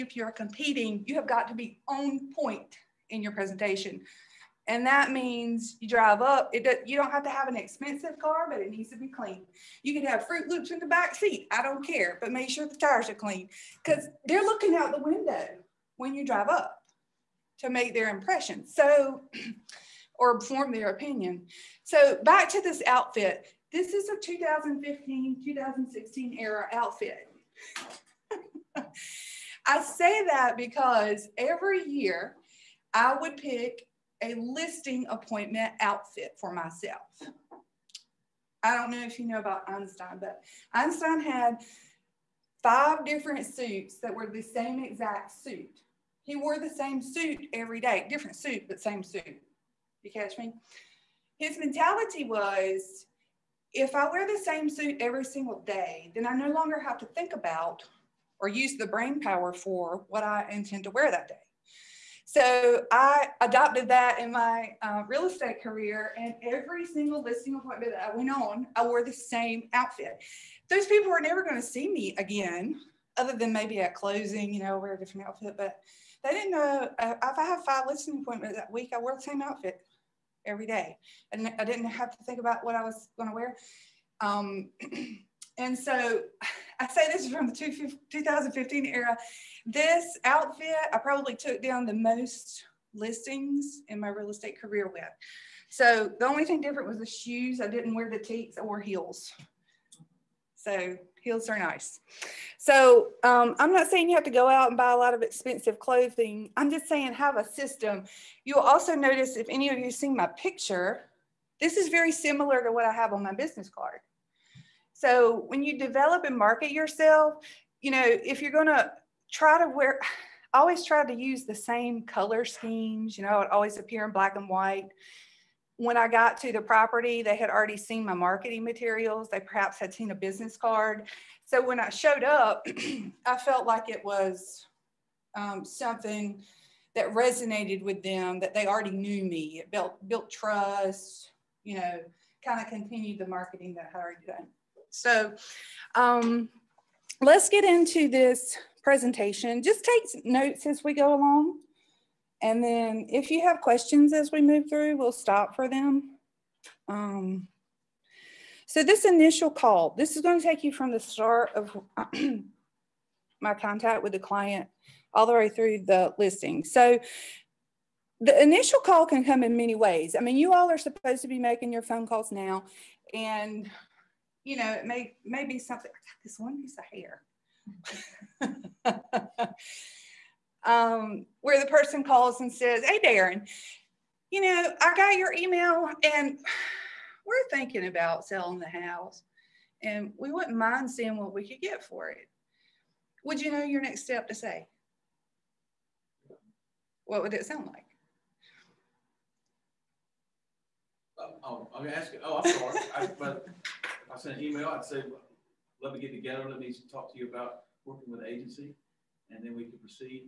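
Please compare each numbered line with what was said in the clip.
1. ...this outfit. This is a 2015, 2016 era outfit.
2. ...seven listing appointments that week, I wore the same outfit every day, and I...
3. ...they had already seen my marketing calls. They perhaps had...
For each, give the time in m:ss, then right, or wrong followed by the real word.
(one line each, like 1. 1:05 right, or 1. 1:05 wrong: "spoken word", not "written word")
1. 0:22 right
2. 1:17 wrong: "five", not "seven"
3. 2:07 wrong: "materials", not "calls".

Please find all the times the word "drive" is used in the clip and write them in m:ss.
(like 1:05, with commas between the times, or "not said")
0:05, 0:16.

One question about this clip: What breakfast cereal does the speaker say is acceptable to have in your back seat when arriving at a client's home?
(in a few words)
Fruit Loops.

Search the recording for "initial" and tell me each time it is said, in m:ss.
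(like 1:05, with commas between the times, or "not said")
2:39, 2:48.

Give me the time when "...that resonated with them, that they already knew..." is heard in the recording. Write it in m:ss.
2:16.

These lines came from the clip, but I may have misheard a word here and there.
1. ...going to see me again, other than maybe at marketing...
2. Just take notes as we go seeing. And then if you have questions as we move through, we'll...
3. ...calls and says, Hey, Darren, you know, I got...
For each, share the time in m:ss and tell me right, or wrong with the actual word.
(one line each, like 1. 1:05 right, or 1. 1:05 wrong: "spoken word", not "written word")
1. 1:11 wrong: "closing", not "marketing"
2. 2:29 wrong: "along", not "seeing"
3. 3:02 right.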